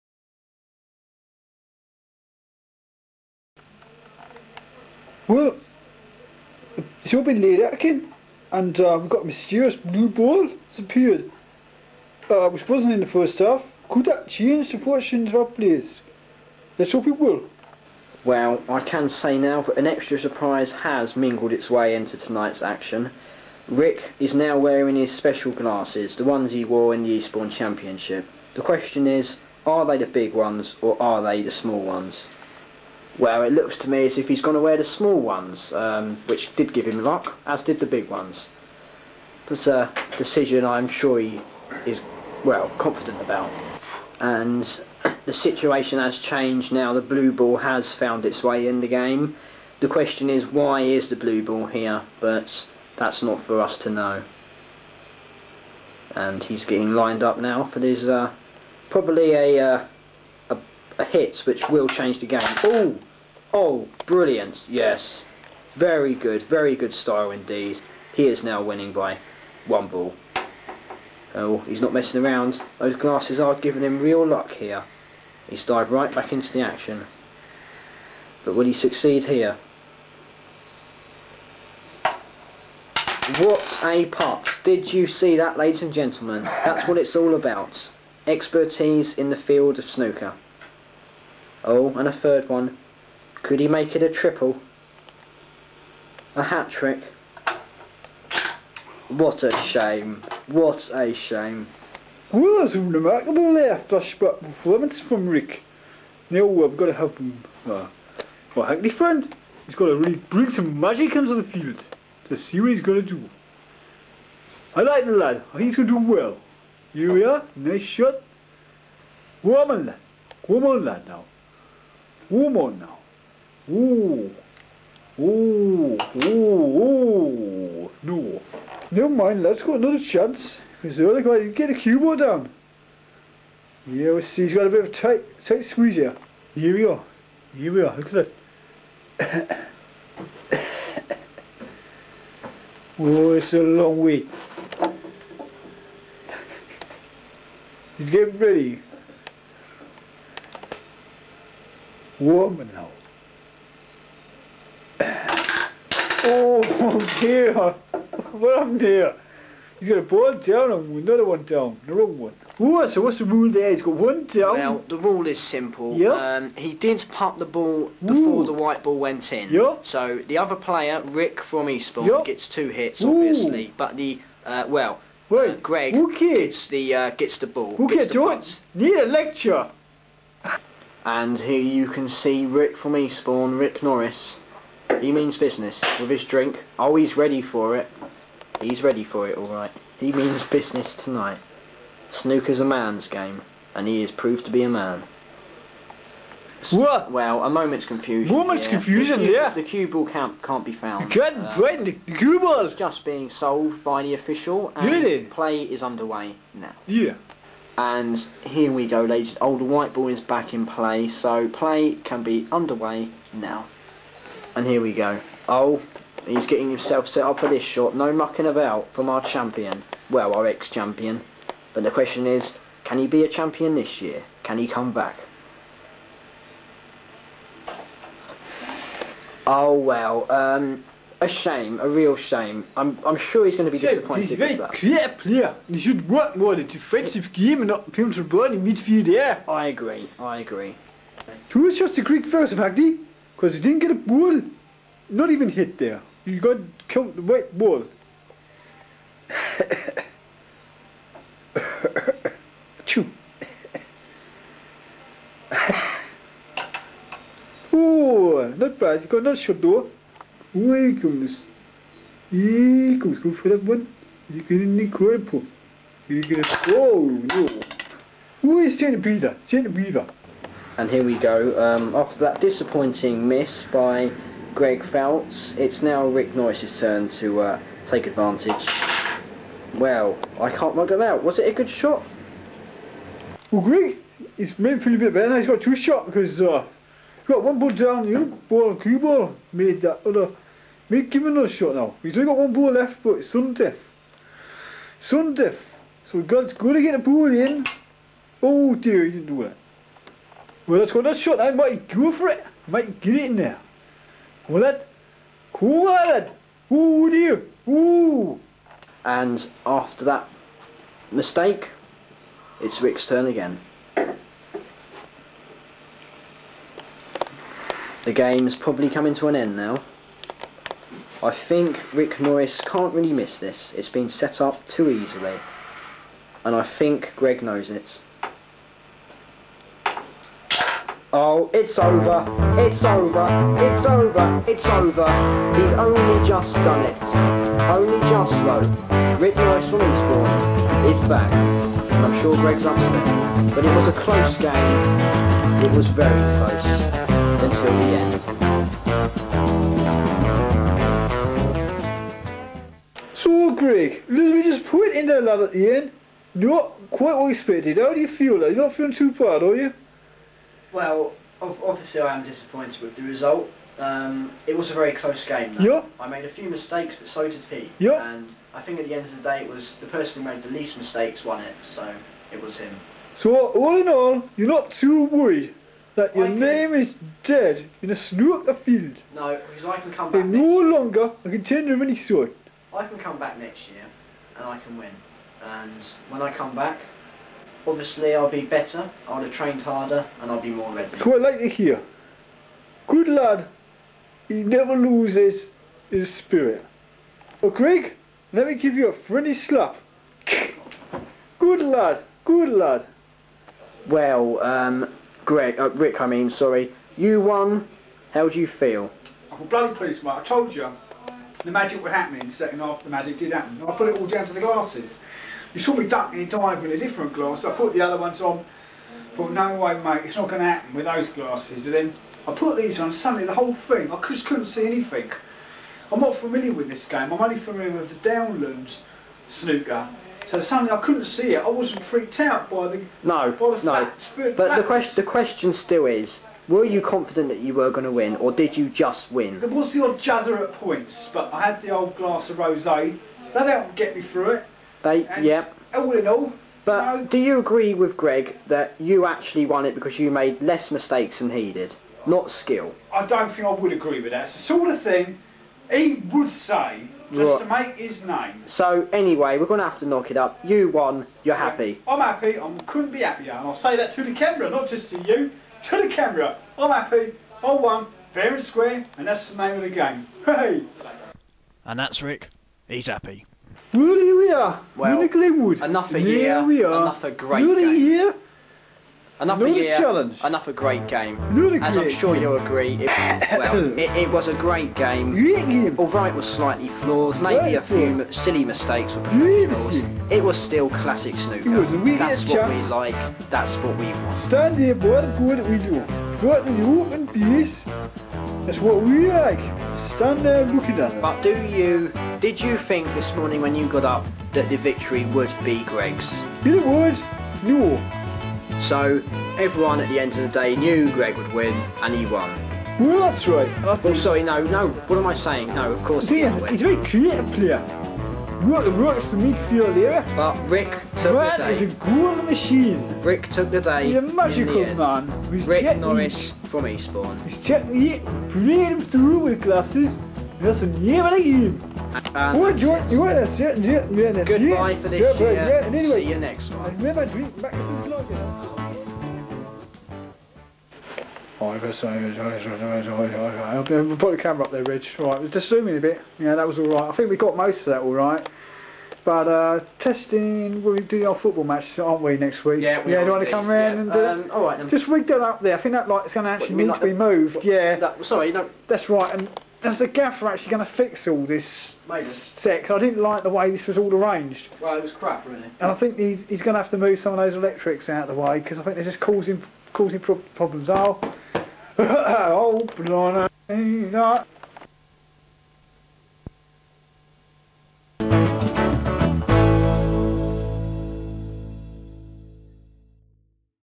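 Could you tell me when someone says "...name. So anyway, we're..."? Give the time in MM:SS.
07:38.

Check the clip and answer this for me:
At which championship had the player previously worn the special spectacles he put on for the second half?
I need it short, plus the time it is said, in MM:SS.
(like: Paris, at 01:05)
Eastbourne Championship, at 00:27.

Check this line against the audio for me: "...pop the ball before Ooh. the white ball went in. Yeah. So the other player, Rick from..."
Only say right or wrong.
right.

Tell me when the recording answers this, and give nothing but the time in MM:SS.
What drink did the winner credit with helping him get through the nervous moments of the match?
07:22.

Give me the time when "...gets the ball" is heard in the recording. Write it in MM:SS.
02:57.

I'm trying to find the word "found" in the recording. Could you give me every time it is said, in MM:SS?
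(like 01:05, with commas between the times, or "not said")
00:47, 03:20.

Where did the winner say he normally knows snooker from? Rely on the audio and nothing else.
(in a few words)
Downlands.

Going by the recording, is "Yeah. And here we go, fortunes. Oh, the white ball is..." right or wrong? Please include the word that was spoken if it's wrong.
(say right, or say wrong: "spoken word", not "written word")
wrong: "ladies", not "fortunes".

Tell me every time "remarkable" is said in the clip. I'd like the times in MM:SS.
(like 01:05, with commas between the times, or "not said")
01:42.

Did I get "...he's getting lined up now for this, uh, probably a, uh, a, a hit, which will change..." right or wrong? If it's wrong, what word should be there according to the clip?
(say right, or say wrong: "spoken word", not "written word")
right.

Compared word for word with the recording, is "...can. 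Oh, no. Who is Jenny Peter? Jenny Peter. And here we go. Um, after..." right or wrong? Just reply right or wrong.
right.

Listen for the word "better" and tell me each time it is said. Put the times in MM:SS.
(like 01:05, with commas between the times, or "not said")
04:45, 06:28.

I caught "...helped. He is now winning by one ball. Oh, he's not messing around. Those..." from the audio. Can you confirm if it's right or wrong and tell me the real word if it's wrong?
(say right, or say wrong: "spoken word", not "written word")
wrong: "indeed", not "helped".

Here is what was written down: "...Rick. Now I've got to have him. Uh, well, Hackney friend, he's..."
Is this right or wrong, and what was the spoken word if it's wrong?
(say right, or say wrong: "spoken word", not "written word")
right.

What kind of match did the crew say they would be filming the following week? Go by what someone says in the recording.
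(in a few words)
Football match.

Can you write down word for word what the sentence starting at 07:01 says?
And then I put these on, suddenly the whole thing, I just couldn't see anything.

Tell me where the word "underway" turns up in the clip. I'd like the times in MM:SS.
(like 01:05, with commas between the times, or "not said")
03:25, 03:32.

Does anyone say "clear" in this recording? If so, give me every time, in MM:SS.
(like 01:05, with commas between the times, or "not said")
03:54.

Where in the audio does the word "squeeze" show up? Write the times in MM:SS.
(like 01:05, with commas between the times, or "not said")
02:15.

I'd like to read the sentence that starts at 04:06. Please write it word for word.
You got killed the right ball.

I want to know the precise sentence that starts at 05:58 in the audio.
You're not feeling too bad, are you?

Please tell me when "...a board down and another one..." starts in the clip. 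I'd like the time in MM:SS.
02:39.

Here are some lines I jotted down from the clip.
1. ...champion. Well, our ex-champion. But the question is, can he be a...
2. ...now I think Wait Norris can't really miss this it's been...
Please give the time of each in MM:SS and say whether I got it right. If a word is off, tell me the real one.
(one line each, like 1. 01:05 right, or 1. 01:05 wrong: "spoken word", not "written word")
1. 03:39 right
2. 05:19 wrong: "Rick", not "Wait".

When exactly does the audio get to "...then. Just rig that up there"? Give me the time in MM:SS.
09:14.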